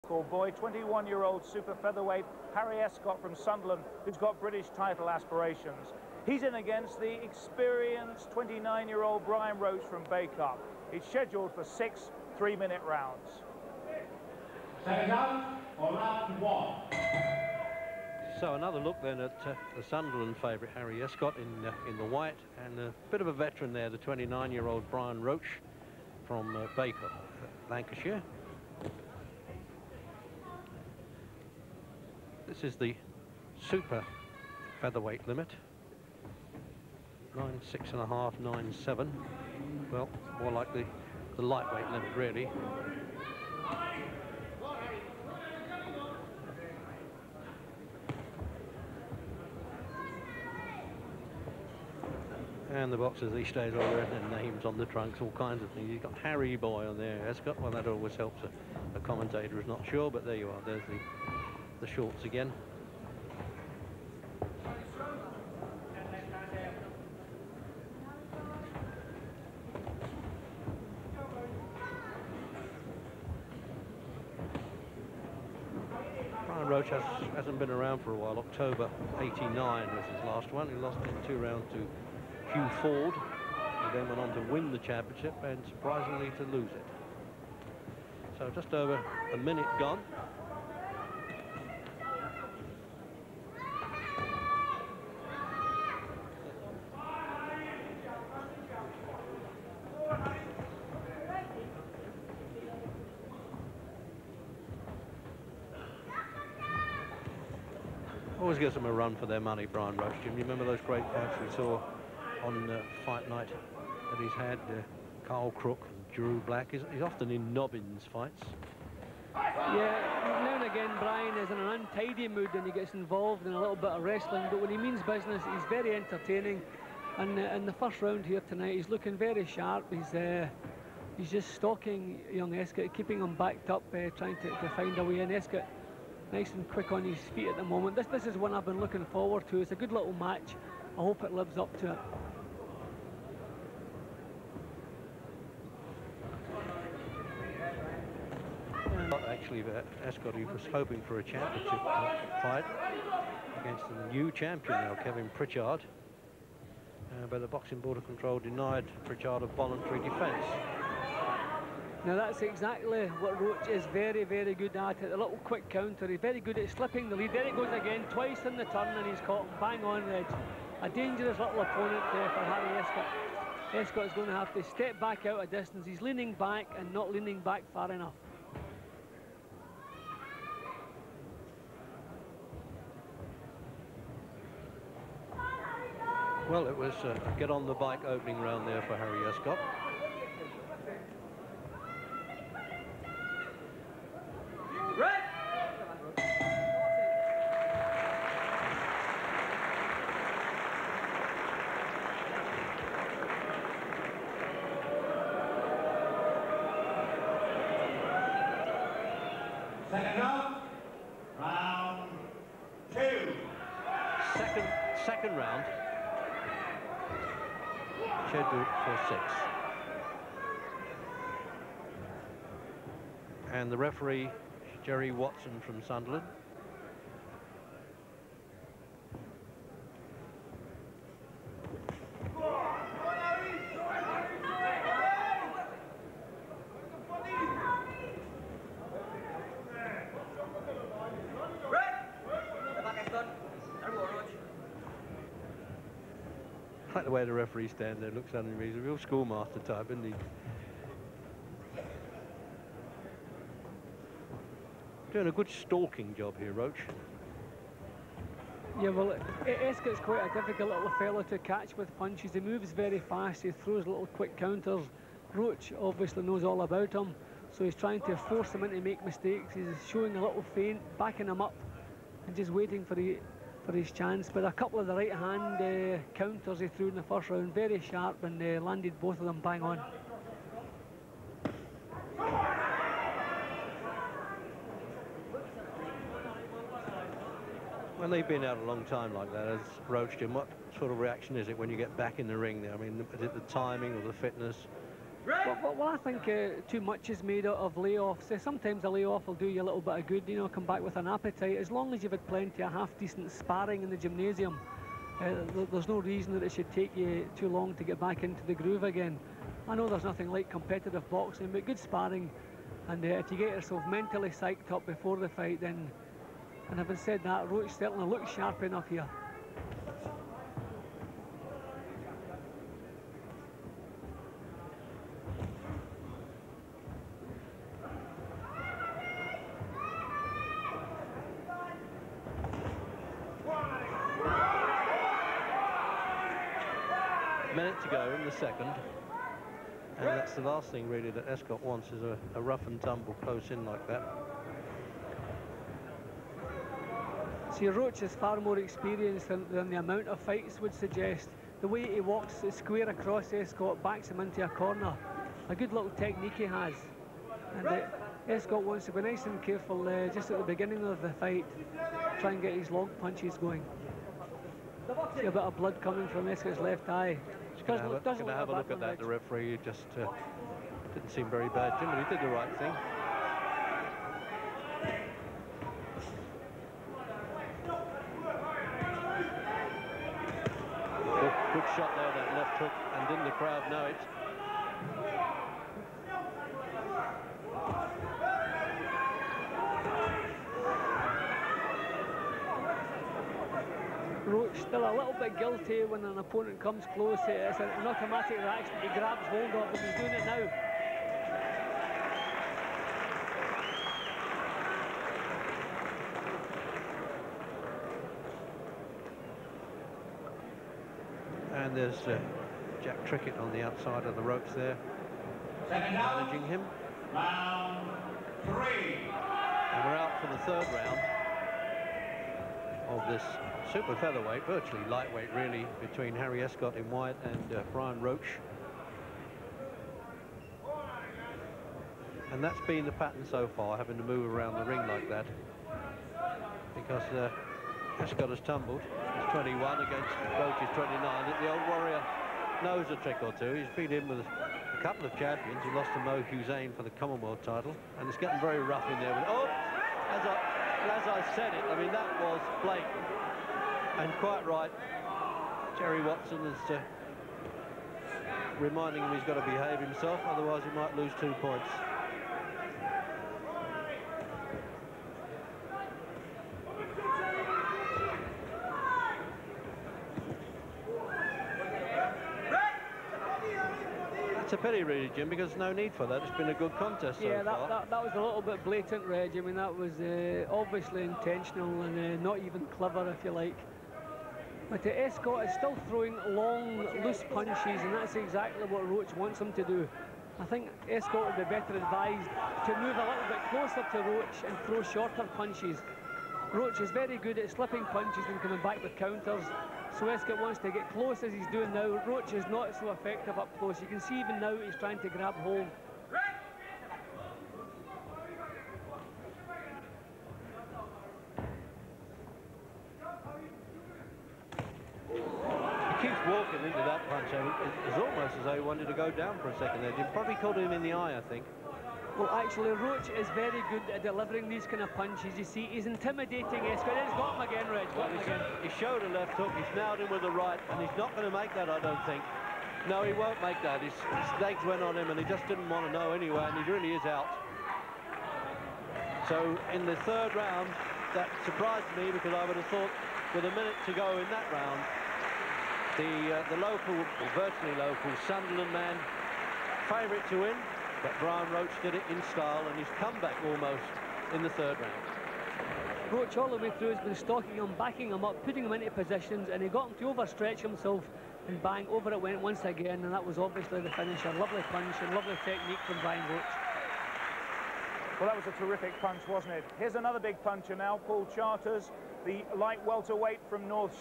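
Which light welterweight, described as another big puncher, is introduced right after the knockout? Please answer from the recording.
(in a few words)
Paul Charters.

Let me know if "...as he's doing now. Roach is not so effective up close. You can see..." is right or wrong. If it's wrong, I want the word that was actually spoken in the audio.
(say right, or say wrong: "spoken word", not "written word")
right.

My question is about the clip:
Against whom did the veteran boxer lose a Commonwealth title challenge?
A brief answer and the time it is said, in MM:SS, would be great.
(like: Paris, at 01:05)
Mo Hussein, at 07:25.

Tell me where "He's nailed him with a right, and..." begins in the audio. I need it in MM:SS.
08:49.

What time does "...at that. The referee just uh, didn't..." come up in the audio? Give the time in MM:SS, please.
06:08.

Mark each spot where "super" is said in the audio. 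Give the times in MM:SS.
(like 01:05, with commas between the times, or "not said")
00:01, 00:33, 07:03.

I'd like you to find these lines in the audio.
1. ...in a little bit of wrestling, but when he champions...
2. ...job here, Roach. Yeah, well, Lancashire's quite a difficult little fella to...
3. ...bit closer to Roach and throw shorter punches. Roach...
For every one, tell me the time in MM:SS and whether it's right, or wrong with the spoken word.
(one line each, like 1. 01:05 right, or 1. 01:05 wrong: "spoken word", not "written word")
1. 02:03 wrong: "means", not "champions"
2. 04:16 wrong: "Escott", not "Lancashire"
3. 08:13 right.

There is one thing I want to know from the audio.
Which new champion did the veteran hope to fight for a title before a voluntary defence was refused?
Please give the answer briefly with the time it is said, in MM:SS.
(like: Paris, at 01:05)
Kevin Pritchard, at 02:35.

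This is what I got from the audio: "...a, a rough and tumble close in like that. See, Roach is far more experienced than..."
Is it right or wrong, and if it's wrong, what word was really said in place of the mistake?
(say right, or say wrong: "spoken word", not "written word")
right.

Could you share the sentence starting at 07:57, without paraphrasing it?
That, that was a little bit blatant, Reg.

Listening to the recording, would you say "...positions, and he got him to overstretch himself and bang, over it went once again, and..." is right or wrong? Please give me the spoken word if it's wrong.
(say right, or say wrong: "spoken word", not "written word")
right.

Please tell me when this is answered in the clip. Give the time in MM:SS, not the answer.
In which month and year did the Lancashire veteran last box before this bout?
01:18.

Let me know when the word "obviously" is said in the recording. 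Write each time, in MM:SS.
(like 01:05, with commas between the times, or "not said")
04:25, 08:00, 09:23.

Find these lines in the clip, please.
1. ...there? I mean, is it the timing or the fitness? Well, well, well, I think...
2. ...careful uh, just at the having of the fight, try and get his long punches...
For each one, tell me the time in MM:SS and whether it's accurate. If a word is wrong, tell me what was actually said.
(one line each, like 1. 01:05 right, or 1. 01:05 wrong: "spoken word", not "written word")
1. 04:52 right
2. 05:59 wrong: "beginning", not "having".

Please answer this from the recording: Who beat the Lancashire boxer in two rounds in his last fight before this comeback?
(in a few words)
Hugh Forde.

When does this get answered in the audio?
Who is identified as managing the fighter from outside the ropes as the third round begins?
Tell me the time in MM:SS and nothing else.
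06:52.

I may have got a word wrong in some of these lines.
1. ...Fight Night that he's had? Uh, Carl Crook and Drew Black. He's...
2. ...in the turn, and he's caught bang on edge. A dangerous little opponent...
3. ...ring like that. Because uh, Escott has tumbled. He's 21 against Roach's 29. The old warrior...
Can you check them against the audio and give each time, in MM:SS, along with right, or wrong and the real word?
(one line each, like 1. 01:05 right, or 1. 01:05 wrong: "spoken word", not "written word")
1. 01:53 right
2. 02:48 right
3. 07:14 right.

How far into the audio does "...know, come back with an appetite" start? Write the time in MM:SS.
05:00.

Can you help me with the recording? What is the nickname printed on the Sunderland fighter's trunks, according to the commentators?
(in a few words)
Harry Boy.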